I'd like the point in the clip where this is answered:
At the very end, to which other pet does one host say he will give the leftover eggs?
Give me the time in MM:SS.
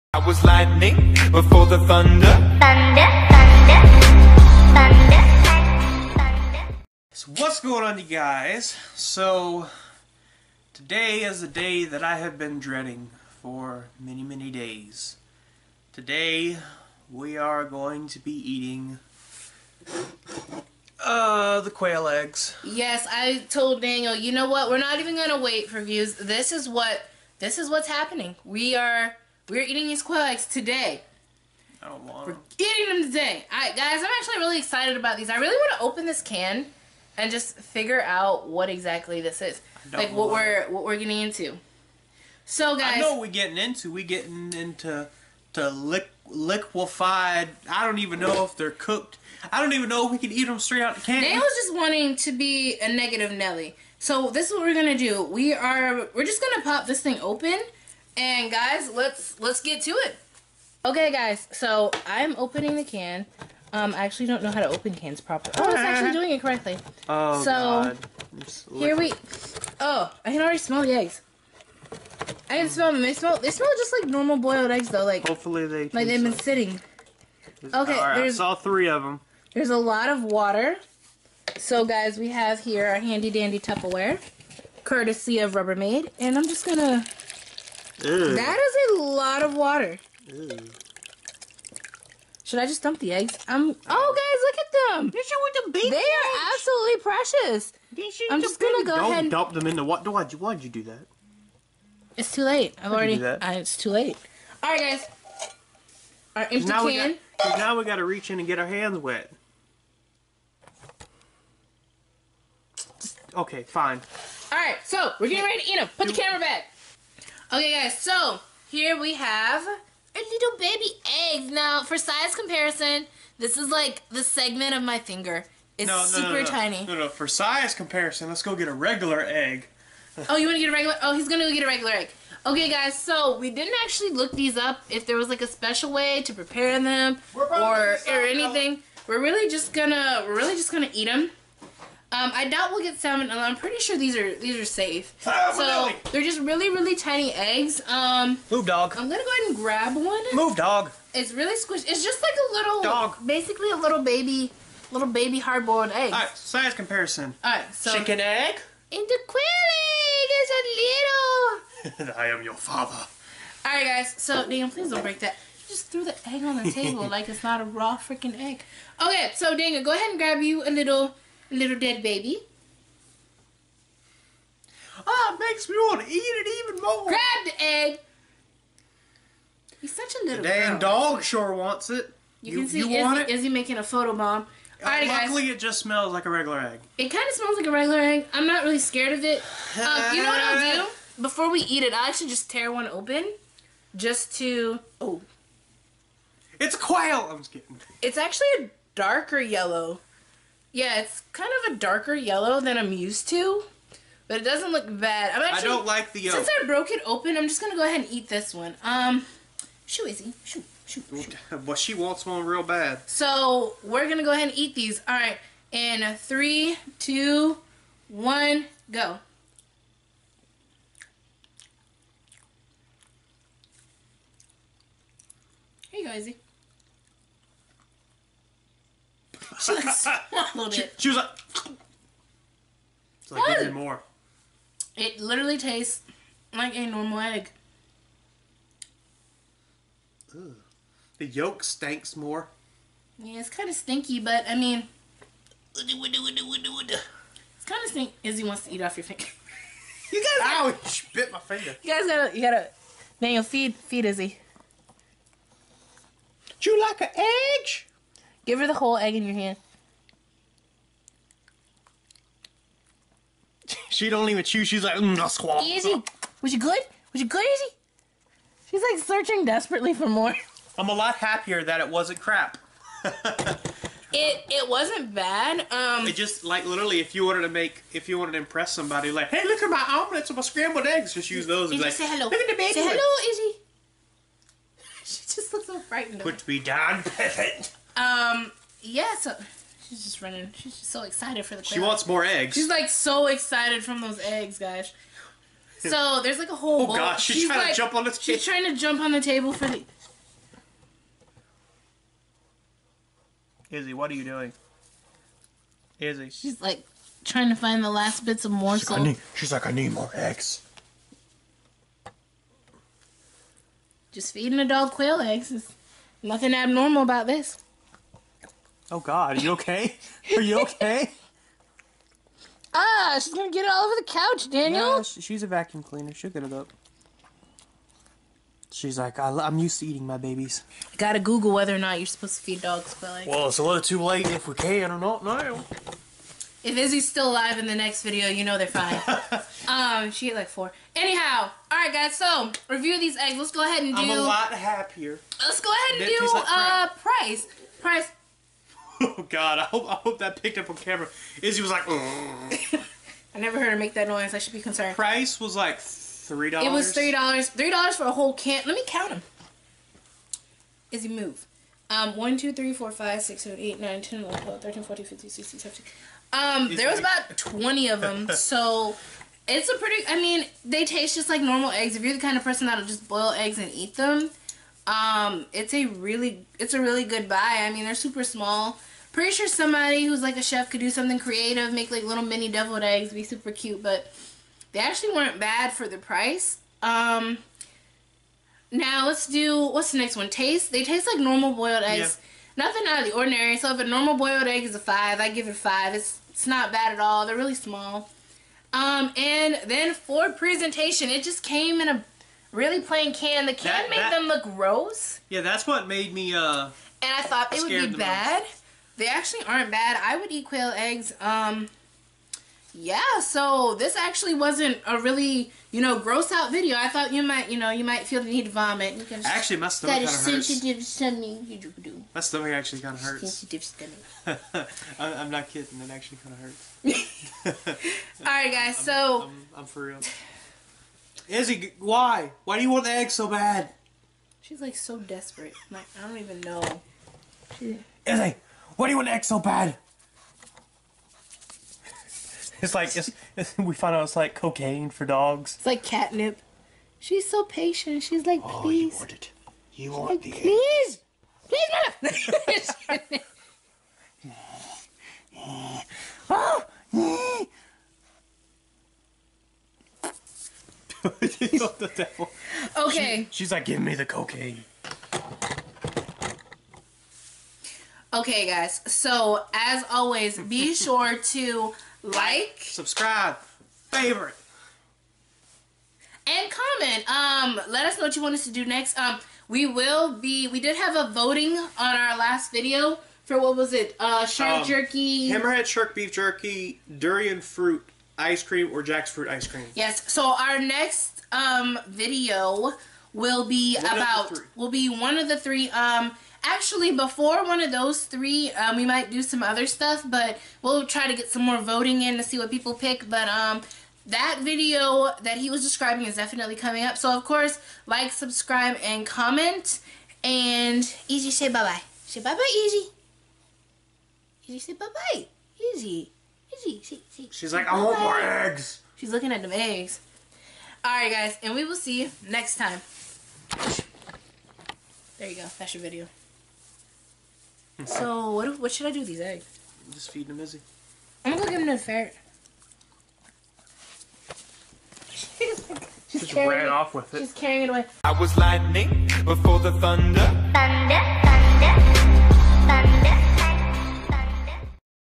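08:51.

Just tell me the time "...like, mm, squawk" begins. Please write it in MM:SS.
04:24.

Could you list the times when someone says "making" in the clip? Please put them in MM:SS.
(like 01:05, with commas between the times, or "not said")
03:03.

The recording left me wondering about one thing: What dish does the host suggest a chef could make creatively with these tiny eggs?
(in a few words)
mini deviled eggs.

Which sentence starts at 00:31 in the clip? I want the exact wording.
I don't want We're eating them today.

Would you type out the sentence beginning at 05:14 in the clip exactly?
Just feeding a dog quail eggs.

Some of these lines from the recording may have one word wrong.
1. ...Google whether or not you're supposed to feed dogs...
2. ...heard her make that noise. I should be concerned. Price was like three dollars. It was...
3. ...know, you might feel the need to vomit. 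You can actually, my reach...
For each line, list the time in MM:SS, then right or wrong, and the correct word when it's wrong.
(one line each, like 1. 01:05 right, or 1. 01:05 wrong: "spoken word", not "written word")
1. 05:31 right
2. 05:53 right
3. 06:57 wrong: "stomach", not "reach".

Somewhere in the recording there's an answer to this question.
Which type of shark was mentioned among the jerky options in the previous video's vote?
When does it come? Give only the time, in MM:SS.
08:05.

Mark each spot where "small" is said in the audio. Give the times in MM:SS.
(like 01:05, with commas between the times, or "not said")
06:18, 06:37.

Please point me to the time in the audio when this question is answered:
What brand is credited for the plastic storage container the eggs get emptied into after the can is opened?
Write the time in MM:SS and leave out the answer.
01:25.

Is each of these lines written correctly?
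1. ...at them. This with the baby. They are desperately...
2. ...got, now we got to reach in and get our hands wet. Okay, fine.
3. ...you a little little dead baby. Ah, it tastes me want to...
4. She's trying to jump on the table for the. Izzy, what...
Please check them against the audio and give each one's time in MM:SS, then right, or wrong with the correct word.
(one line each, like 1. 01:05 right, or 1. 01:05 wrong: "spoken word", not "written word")
1. 01:34 wrong: "absolutely", not "desperately"
2. 01:47 right
3. 02:50 wrong: "makes", not "tastes"
4. 04:58 right.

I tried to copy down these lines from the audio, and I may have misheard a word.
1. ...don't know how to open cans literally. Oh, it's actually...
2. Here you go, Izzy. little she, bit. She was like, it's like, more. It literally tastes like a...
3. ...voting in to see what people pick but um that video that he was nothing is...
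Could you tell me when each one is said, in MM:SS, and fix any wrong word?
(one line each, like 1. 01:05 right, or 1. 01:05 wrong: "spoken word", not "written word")
1. 01:04 wrong: "properly", not "literally"
2. 03:45 right
3. 08:21 wrong: "describing", not "nothing".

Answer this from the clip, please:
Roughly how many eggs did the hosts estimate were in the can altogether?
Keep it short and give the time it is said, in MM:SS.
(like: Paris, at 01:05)
20, at 06:06.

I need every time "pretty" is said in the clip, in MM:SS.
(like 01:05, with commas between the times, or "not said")
02:23, 06:09, 06:19.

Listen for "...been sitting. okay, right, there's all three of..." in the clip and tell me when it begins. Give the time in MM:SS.
01:16.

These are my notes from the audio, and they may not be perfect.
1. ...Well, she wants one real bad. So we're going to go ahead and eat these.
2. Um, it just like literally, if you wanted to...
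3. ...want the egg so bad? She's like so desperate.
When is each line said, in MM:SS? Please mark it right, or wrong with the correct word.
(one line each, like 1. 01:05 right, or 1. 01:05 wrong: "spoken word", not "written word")
1. 03:31 right
2. 04:35 right
3. 07:12 right.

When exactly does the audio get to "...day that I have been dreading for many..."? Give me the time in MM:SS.
00:11.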